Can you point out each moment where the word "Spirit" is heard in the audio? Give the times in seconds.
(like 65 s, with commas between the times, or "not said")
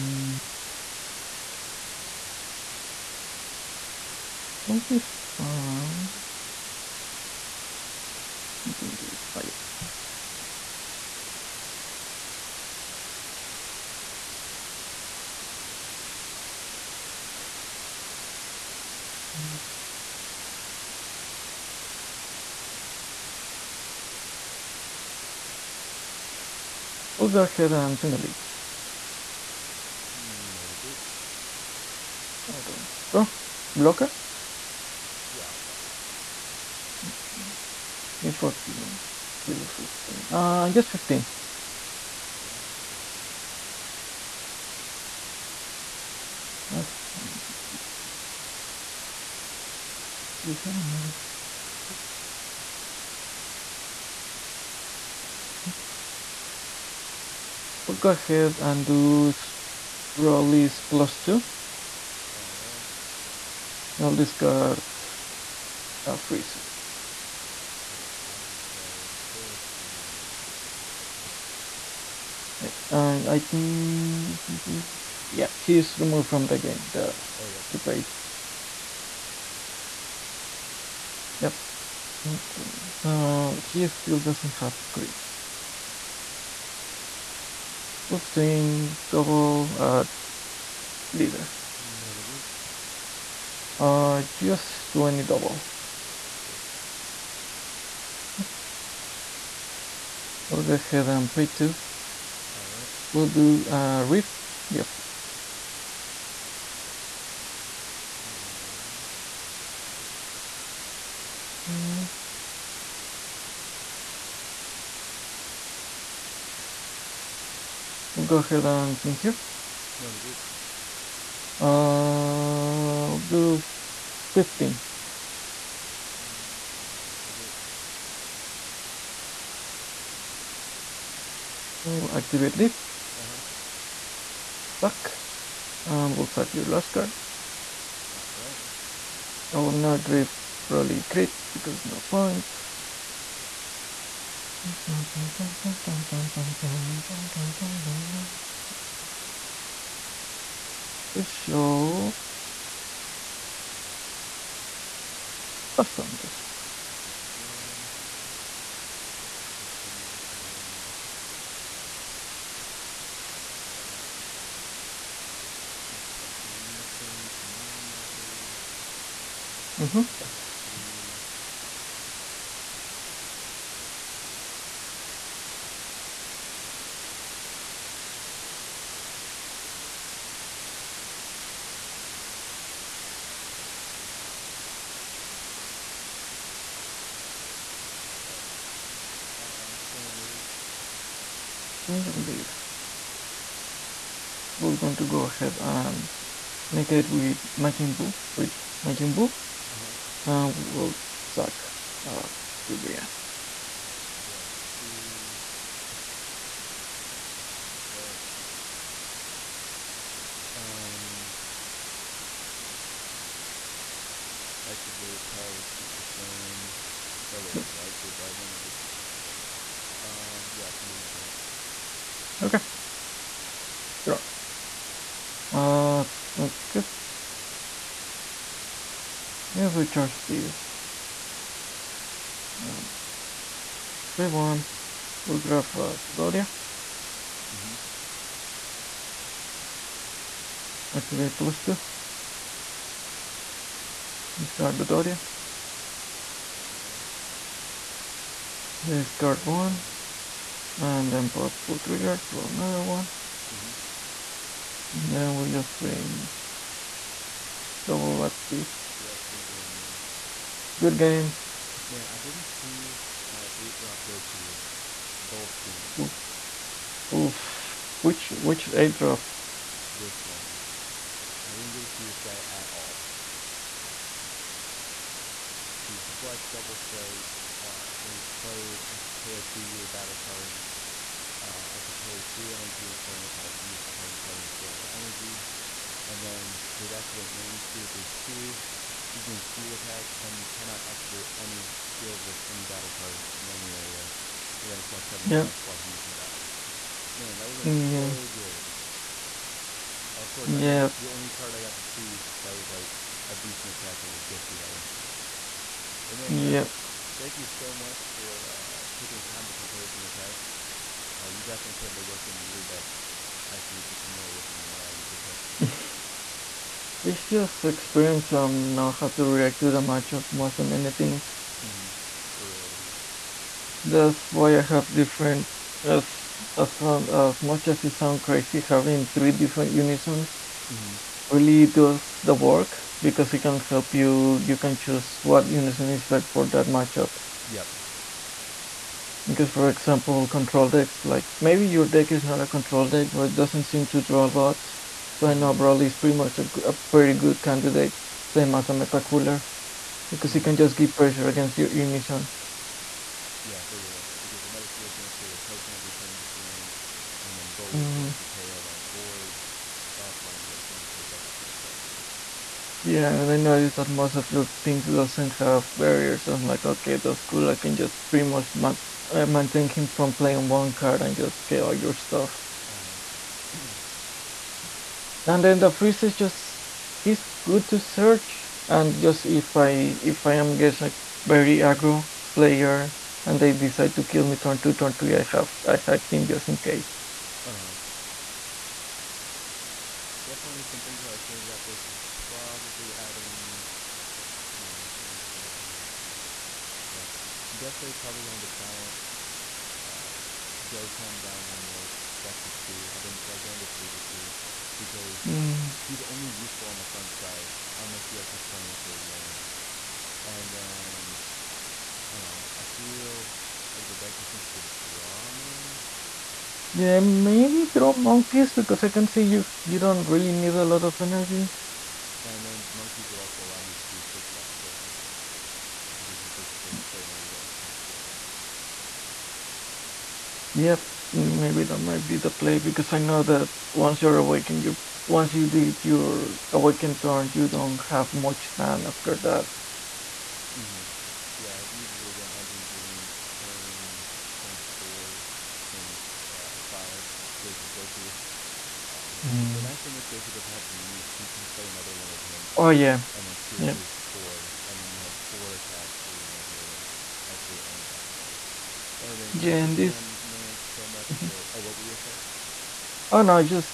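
287 s, 453 s.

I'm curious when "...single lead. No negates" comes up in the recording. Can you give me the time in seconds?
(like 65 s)
27 s.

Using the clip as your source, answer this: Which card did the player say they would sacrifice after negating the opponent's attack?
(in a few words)
Ribrianne.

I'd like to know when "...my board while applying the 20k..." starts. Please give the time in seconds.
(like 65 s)
358 s.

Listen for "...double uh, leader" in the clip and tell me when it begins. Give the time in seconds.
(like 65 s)
89 s.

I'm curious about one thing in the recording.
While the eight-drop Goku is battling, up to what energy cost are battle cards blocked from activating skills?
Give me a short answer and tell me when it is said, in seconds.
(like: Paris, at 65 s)
7 or less, at 295 s.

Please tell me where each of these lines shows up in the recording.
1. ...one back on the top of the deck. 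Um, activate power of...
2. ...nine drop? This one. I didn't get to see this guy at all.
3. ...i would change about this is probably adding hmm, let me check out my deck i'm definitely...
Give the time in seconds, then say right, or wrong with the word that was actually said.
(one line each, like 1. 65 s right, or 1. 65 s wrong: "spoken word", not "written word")
1. 206 s right
2. 268 s wrong: "eight", not "nine"
3. 391 s right.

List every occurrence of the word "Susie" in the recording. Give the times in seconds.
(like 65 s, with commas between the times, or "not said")
not said.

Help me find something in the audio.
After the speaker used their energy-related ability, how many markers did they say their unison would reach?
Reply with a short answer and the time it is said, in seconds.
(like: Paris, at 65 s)
9, at 167 s.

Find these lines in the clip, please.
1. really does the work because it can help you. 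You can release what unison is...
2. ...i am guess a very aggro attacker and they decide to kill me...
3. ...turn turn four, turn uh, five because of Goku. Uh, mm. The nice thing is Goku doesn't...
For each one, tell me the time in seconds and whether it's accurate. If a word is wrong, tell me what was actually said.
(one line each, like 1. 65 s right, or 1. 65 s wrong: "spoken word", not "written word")
1. 331 s wrong: "choose", not "release"
2. 380 s wrong: "player", not "attacker"
3. 443 s right.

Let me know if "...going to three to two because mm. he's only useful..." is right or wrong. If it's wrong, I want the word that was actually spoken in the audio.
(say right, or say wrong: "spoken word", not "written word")
right.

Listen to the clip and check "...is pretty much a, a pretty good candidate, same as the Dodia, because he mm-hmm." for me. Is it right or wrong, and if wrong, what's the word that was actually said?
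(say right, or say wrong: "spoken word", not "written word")
wrong: "Cooler", not "Dodia".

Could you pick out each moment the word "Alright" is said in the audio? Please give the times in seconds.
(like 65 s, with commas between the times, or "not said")
138 s, 246 s.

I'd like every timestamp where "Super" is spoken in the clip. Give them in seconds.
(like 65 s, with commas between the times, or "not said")
77 s, 215 s.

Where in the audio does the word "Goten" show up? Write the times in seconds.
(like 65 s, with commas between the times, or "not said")
400 s, 424 s.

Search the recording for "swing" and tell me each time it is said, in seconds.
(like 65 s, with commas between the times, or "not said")
189 s, 255 s, 356 s.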